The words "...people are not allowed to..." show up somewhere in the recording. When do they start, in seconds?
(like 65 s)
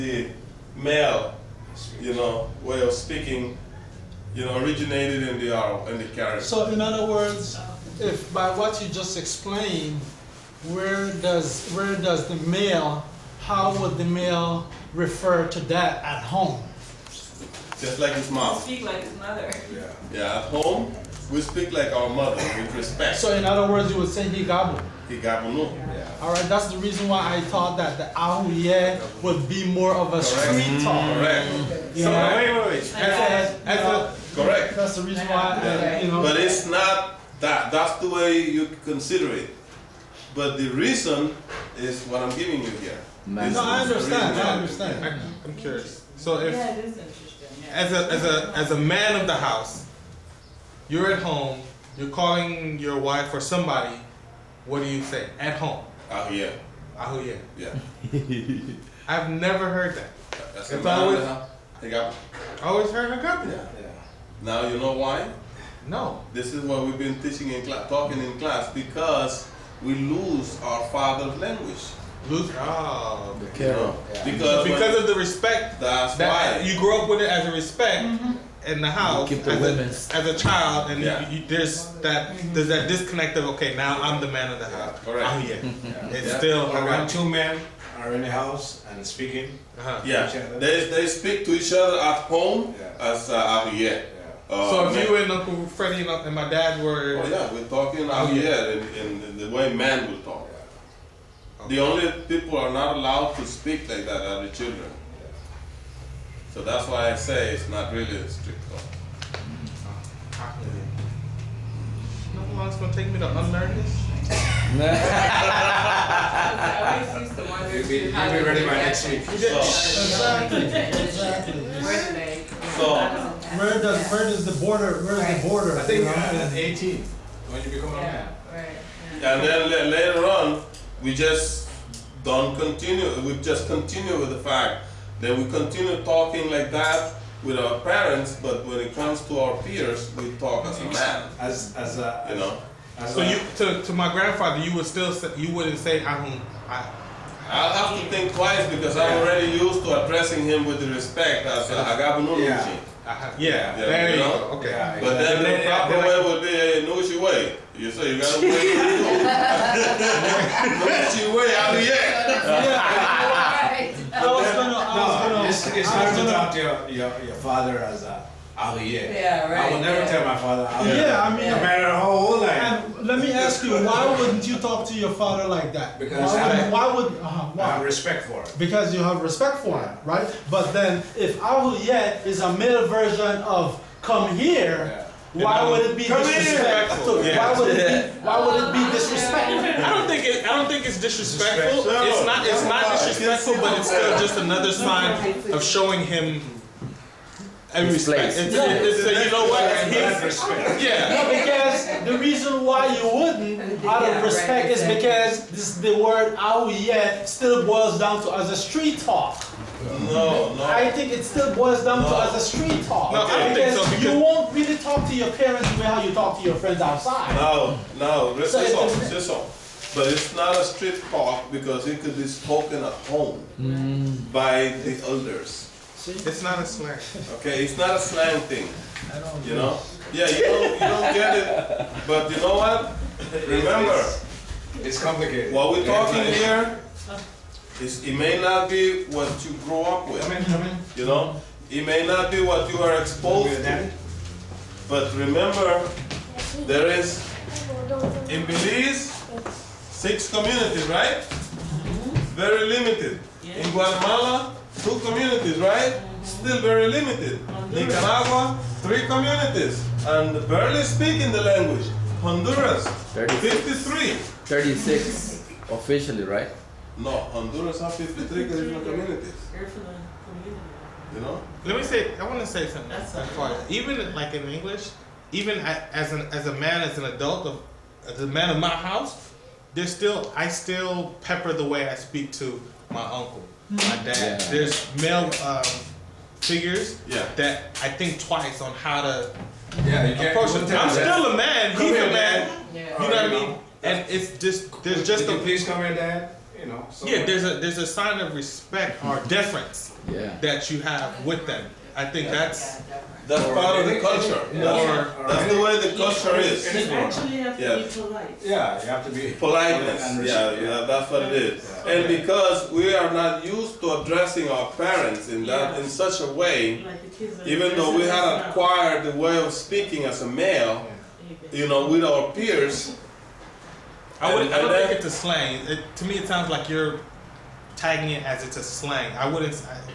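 102 s.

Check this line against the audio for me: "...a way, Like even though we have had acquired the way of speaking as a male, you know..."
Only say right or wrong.
right.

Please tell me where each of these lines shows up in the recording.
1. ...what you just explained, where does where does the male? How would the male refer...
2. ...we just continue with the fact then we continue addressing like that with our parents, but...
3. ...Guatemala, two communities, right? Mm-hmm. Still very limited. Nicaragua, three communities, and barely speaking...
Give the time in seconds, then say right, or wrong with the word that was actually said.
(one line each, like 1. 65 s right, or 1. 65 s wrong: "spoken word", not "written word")
1. 8 s right
2. 133 s wrong: "talking", not "addressing"
3. 253 s right.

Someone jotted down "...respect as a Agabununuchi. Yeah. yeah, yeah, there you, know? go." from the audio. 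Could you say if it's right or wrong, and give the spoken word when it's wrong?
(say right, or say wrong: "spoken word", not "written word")
right.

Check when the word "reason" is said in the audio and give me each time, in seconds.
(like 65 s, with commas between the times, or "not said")
26 s, 35 s, 40 s, 202 s.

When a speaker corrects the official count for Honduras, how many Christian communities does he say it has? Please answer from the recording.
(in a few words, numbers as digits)
53.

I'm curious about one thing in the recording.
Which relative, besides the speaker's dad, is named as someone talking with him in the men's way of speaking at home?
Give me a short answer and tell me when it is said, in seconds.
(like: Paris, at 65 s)
Uncle Freddie, at 95 s.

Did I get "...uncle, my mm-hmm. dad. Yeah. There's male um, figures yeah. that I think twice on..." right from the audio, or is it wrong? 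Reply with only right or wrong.
right.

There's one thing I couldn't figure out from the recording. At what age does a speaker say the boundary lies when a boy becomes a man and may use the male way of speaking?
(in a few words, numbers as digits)
18.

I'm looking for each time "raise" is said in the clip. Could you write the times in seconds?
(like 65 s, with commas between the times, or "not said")
not said.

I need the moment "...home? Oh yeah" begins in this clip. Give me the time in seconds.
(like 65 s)
55 s.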